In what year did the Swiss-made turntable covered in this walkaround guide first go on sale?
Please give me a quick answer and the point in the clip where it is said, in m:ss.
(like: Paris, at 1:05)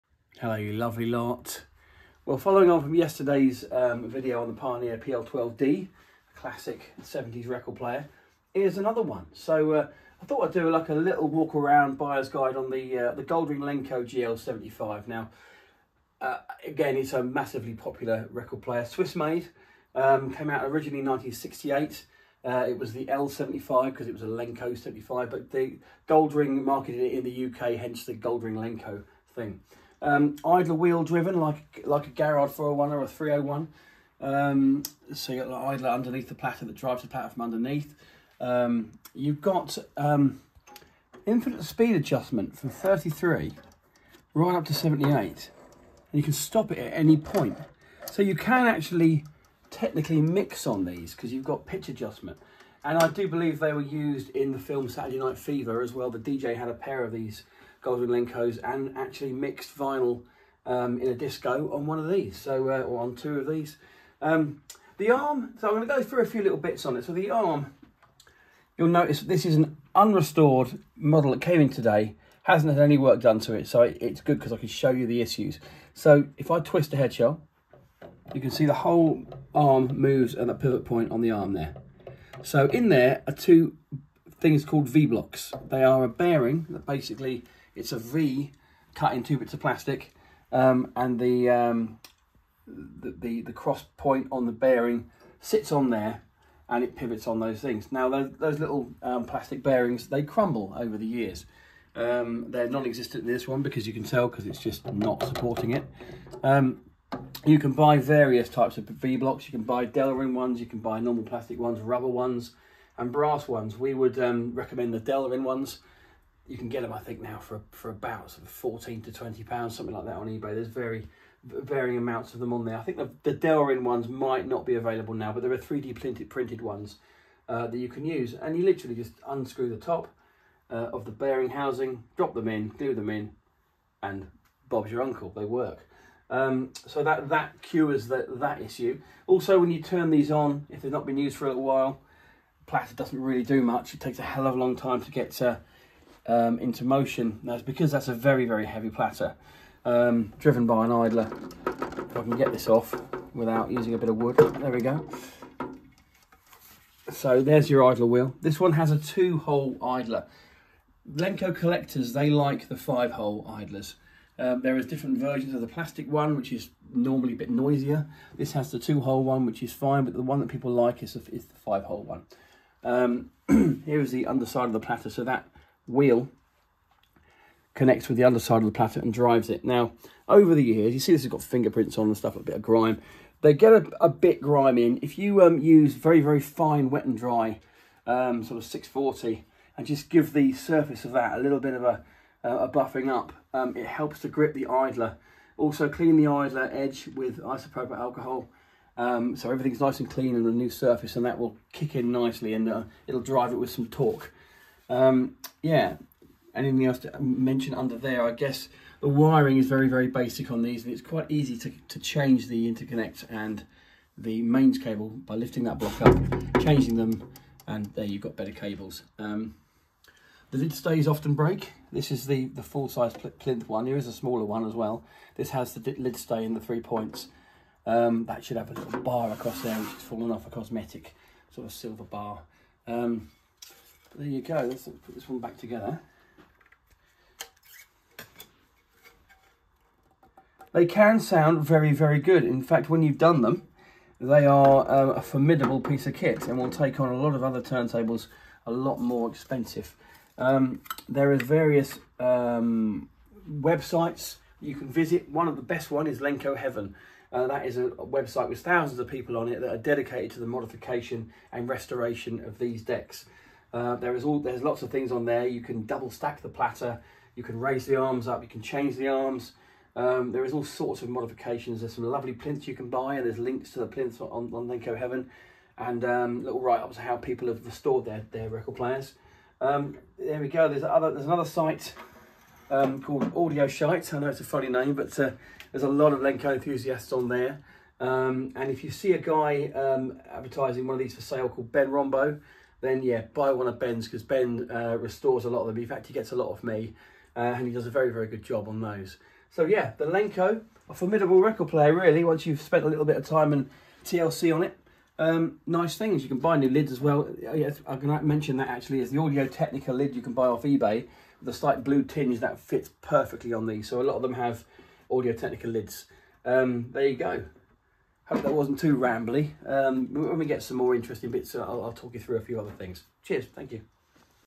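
1968, at 0:21.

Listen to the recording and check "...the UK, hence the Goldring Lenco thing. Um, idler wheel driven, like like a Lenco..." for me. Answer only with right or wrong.
wrong.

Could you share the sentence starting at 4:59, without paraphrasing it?
So yeah, the Lenco, a formidable record player really, once you've spent a little bit of time and TLC on it.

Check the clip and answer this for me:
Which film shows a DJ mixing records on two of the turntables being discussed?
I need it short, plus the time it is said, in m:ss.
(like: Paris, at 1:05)
Saturday Night Fever, at 0:54.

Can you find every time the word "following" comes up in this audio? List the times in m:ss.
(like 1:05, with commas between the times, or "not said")
0:02.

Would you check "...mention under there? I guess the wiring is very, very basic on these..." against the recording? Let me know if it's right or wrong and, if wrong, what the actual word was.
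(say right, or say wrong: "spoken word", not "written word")
right.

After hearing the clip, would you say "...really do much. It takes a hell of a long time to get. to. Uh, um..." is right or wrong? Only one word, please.
right.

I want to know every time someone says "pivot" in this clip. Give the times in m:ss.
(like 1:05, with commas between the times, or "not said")
1:20, 1:36.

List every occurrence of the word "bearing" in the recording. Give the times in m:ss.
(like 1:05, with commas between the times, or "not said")
1:26, 1:34, 1:39, 2:11.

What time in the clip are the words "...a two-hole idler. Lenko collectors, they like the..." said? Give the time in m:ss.
2:38.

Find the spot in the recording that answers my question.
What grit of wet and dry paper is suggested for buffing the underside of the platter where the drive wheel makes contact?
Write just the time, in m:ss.
3:08.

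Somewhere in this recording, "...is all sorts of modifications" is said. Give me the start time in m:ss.
4:30.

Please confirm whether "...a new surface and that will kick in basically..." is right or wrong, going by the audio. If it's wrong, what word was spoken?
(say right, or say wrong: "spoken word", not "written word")
wrong: "nicely", not "basically".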